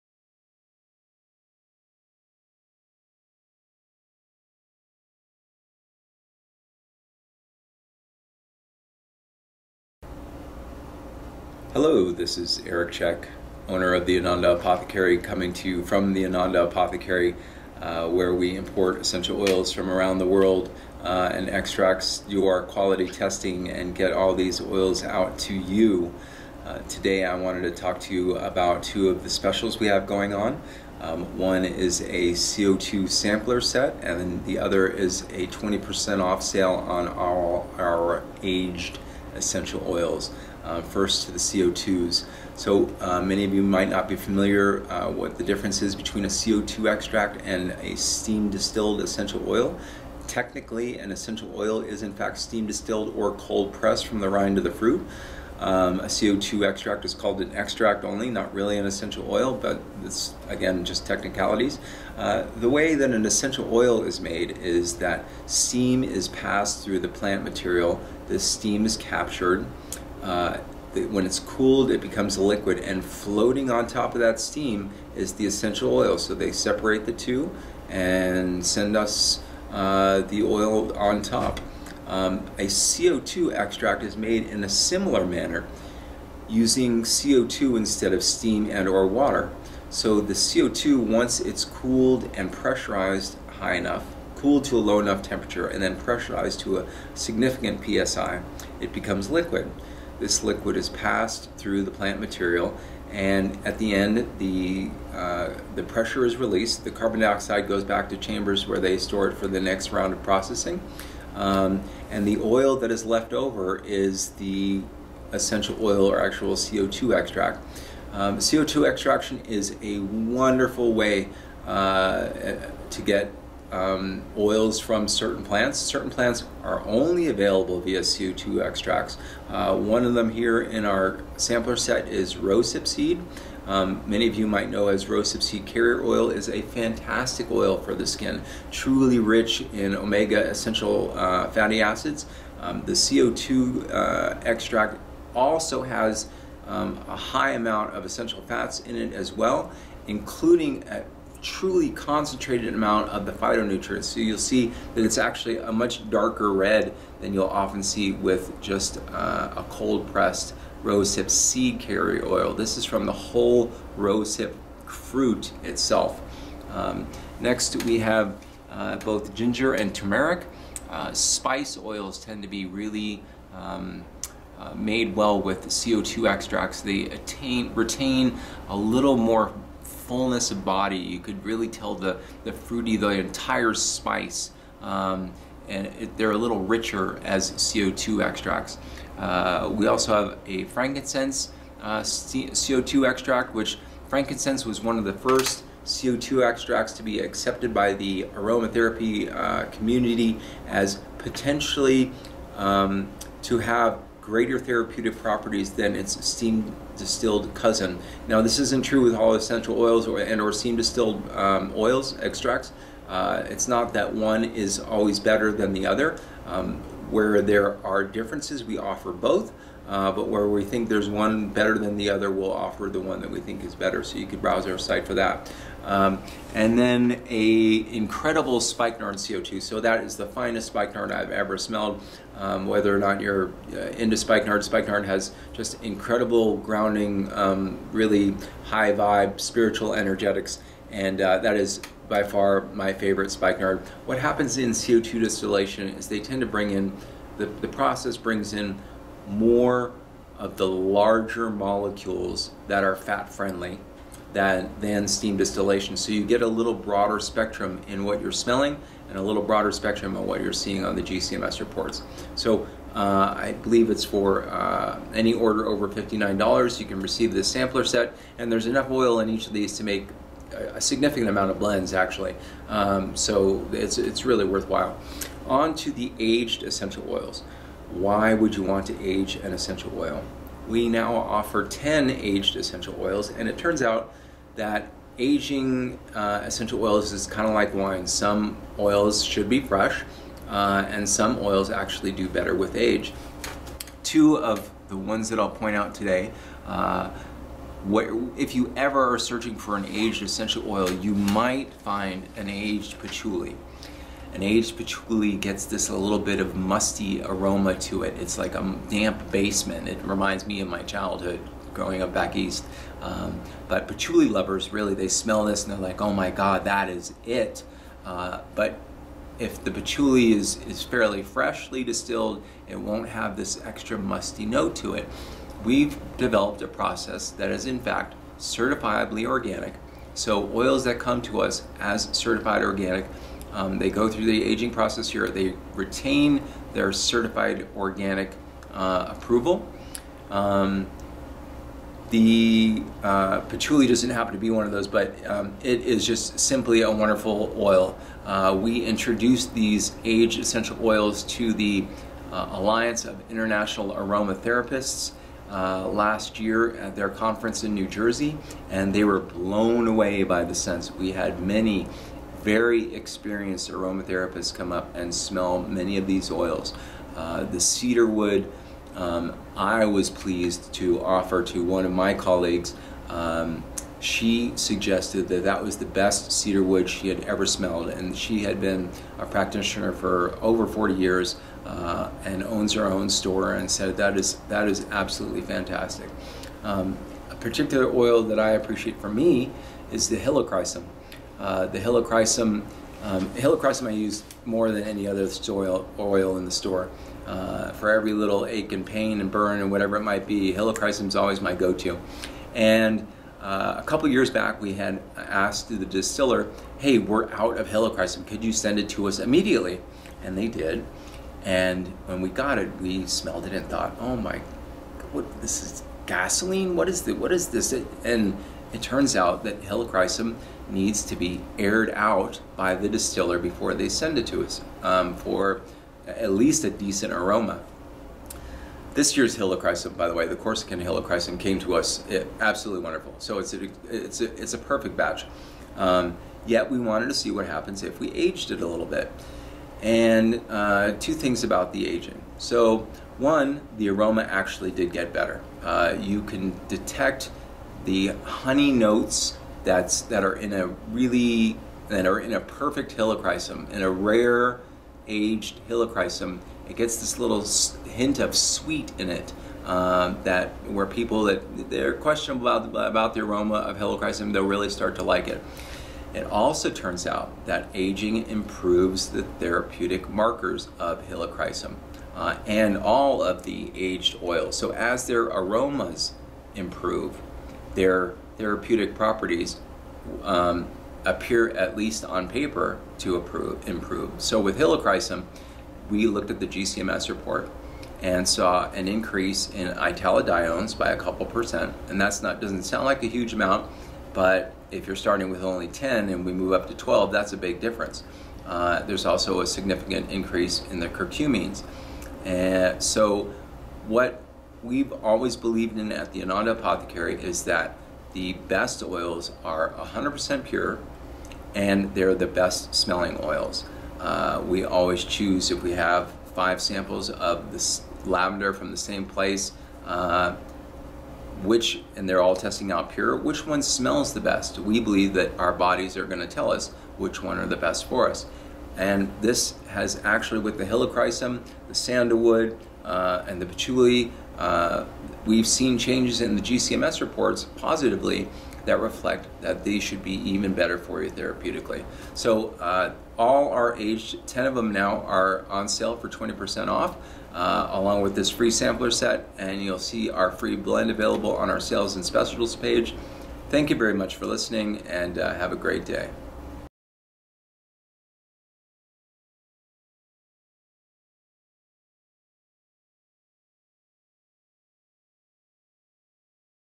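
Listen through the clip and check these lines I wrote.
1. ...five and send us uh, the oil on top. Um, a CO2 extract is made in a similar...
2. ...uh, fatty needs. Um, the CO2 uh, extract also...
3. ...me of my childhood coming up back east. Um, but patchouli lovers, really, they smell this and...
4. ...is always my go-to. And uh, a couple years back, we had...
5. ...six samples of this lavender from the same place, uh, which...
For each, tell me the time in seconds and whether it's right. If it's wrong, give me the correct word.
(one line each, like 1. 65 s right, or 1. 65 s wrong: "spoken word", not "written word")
1. 77 s wrong: "two", not "five"
2. 141 s wrong: "acids", not "needs"
3. 310 s wrong: "growing", not "coming"
4. 401 s right
5. 516 s wrong: "five", not "six".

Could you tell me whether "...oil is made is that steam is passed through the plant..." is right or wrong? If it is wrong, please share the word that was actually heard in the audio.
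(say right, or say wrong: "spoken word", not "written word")
right.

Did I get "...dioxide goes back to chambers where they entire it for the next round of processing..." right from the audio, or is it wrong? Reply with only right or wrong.
wrong.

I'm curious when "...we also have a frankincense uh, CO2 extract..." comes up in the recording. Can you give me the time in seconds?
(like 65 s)
189 s.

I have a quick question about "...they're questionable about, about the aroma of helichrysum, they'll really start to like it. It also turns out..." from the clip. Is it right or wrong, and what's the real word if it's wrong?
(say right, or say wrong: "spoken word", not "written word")
right.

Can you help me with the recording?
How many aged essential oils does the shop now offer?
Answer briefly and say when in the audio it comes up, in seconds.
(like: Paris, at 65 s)
10, at 281 s.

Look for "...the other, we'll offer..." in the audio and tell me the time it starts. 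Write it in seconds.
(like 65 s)
221 s.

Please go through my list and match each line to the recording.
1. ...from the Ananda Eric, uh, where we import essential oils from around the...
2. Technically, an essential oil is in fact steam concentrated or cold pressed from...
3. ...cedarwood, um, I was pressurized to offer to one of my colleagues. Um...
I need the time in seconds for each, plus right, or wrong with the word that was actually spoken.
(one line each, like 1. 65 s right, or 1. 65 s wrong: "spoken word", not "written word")
1. 15 s wrong: "Apothecary", not "Eric"
2. 50 s wrong: "distilled", not "concentrated"
3. 367 s wrong: "pleased", not "pressurized".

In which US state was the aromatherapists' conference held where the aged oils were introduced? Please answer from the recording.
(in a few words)
New Jersey.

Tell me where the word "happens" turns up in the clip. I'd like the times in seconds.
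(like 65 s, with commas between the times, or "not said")
244 s, 344 s, 437 s.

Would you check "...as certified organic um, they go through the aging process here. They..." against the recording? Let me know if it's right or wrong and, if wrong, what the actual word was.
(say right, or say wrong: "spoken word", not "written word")
right.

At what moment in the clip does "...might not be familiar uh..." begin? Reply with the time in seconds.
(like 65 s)
43 s.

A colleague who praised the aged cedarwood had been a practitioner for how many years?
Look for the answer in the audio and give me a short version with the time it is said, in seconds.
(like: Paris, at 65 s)
Over 40, at 380 s.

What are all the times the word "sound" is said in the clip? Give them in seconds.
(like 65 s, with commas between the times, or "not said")
492 s.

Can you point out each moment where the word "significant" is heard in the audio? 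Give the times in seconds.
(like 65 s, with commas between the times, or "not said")
97 s, 270 s, 499 s.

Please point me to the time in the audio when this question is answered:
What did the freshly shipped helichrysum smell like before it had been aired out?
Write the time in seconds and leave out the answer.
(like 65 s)
416 s.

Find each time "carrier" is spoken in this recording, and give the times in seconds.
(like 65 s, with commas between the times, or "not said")
135 s, 161 s.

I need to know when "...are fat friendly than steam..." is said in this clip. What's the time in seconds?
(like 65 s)
252 s.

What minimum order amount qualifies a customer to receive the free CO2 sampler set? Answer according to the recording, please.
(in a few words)
$59.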